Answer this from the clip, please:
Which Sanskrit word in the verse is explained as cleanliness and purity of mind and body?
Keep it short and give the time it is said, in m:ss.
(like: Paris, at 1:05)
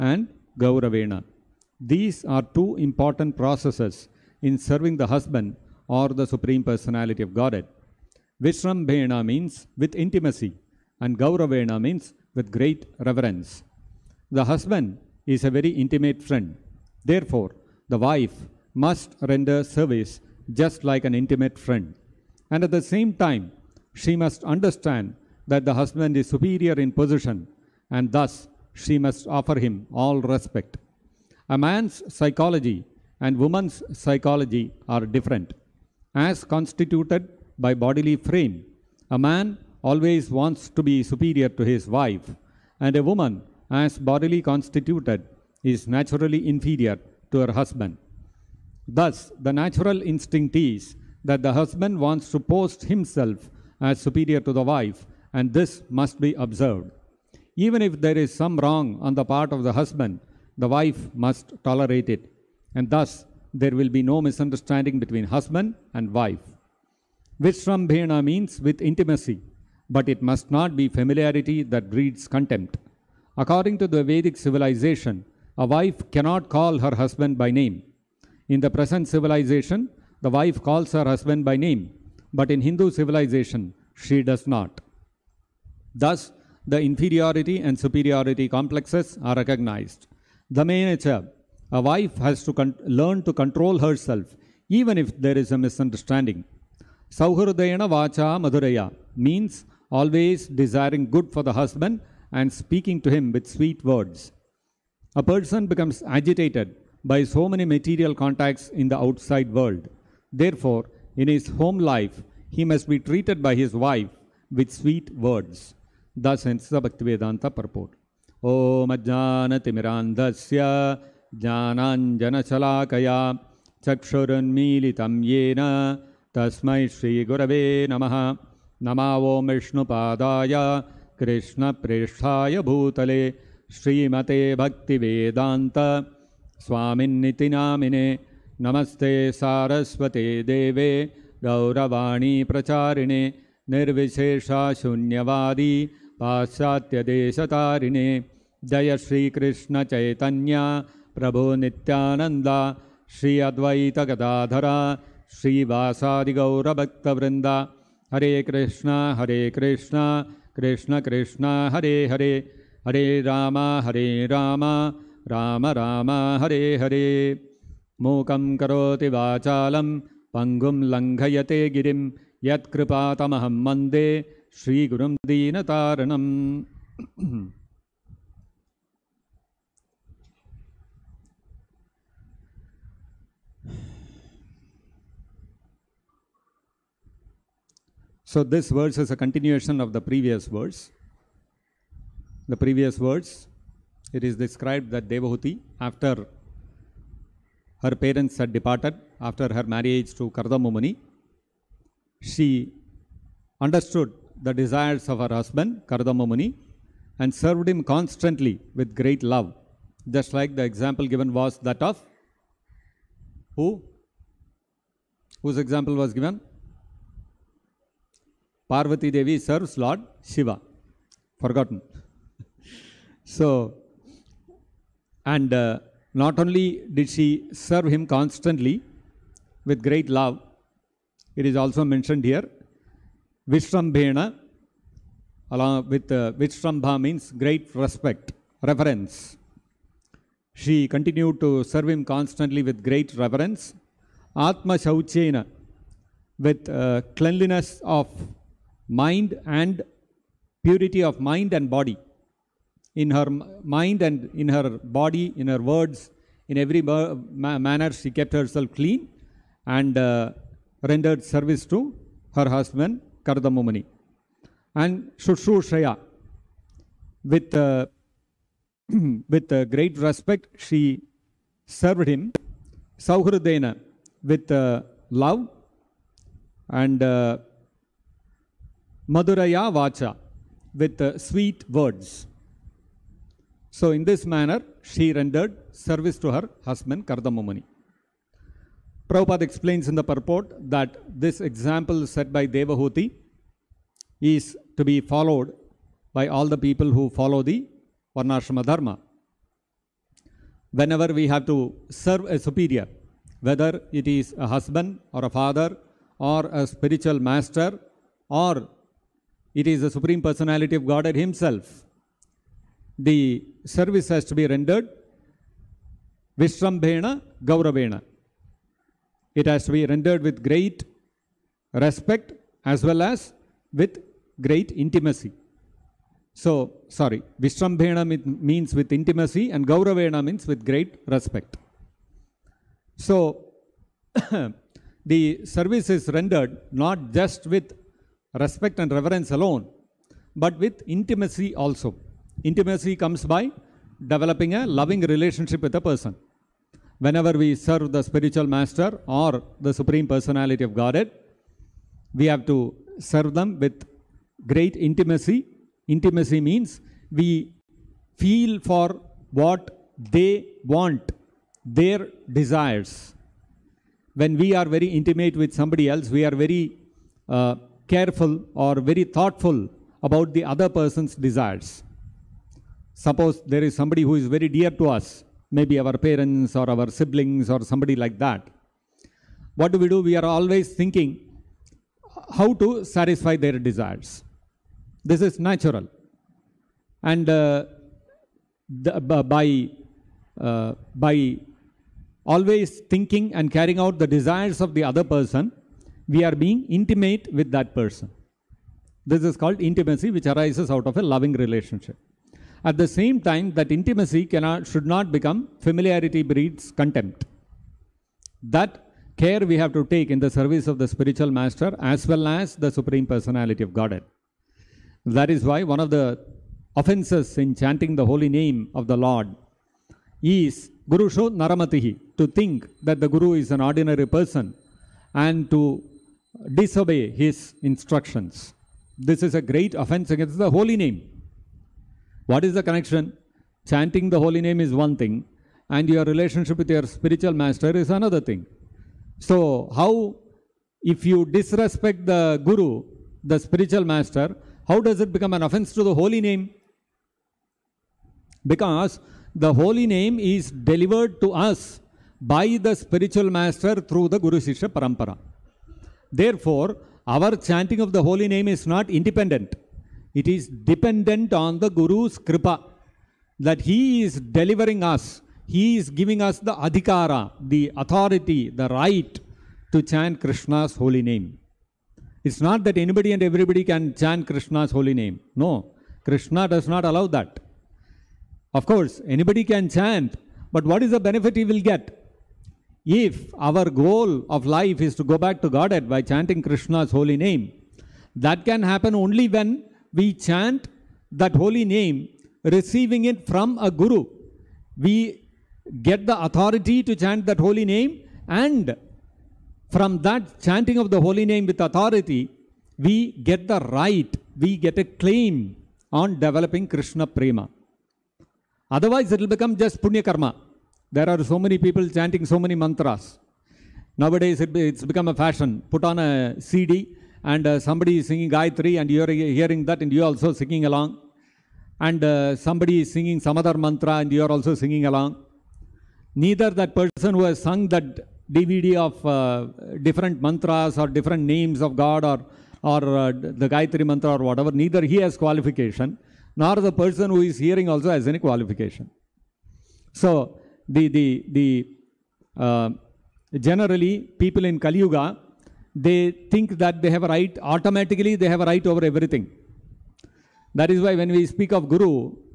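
Atma Shauchena, at 4:04.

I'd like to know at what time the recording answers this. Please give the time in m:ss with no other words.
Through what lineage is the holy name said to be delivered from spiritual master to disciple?
7:34.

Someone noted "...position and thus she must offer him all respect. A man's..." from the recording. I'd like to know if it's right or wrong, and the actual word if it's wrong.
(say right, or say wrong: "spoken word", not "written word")
right.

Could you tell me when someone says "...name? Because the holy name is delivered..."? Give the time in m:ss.
7:26.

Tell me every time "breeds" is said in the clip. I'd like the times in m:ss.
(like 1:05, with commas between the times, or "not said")
1:11, 6:46.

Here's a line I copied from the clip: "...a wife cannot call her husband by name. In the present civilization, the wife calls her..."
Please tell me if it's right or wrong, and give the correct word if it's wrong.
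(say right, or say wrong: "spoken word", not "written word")
right.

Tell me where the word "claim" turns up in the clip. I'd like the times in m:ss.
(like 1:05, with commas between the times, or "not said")
8:24.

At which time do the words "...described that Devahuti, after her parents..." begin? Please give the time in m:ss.
3:14.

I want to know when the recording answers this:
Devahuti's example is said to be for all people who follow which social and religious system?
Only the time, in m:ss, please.
4:58.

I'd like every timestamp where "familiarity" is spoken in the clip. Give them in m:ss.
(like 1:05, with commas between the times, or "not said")
1:10, 6:45.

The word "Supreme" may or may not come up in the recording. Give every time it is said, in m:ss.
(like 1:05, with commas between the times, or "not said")
0:06, 5:09, 5:49, 6:52.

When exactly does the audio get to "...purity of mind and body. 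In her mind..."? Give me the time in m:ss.
4:10.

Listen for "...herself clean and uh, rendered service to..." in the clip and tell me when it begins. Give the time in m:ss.
4:18.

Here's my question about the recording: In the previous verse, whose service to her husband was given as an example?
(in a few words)
Parvati Devi.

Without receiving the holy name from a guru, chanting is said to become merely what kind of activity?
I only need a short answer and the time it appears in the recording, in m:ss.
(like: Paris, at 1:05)
Punya Karma, at 8:29.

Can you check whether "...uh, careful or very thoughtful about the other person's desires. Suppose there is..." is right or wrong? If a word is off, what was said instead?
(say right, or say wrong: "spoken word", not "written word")
right.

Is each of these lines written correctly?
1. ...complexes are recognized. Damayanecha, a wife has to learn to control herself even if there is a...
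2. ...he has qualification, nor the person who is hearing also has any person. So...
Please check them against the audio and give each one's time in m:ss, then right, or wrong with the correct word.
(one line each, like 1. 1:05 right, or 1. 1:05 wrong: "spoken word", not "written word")
1. 1:28 right
2. 8:54 wrong: "qualification", not "person".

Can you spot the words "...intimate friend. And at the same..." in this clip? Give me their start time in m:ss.
0:21.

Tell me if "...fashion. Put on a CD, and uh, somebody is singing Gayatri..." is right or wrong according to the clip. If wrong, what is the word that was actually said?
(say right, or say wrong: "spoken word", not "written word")
right.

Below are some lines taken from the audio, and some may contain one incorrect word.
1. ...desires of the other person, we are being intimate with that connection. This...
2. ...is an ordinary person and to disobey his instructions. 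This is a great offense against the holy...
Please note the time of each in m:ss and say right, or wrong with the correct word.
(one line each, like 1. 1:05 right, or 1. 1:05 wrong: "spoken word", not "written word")
1. 6:34 wrong: "person", not "connection"
2. 7:03 right.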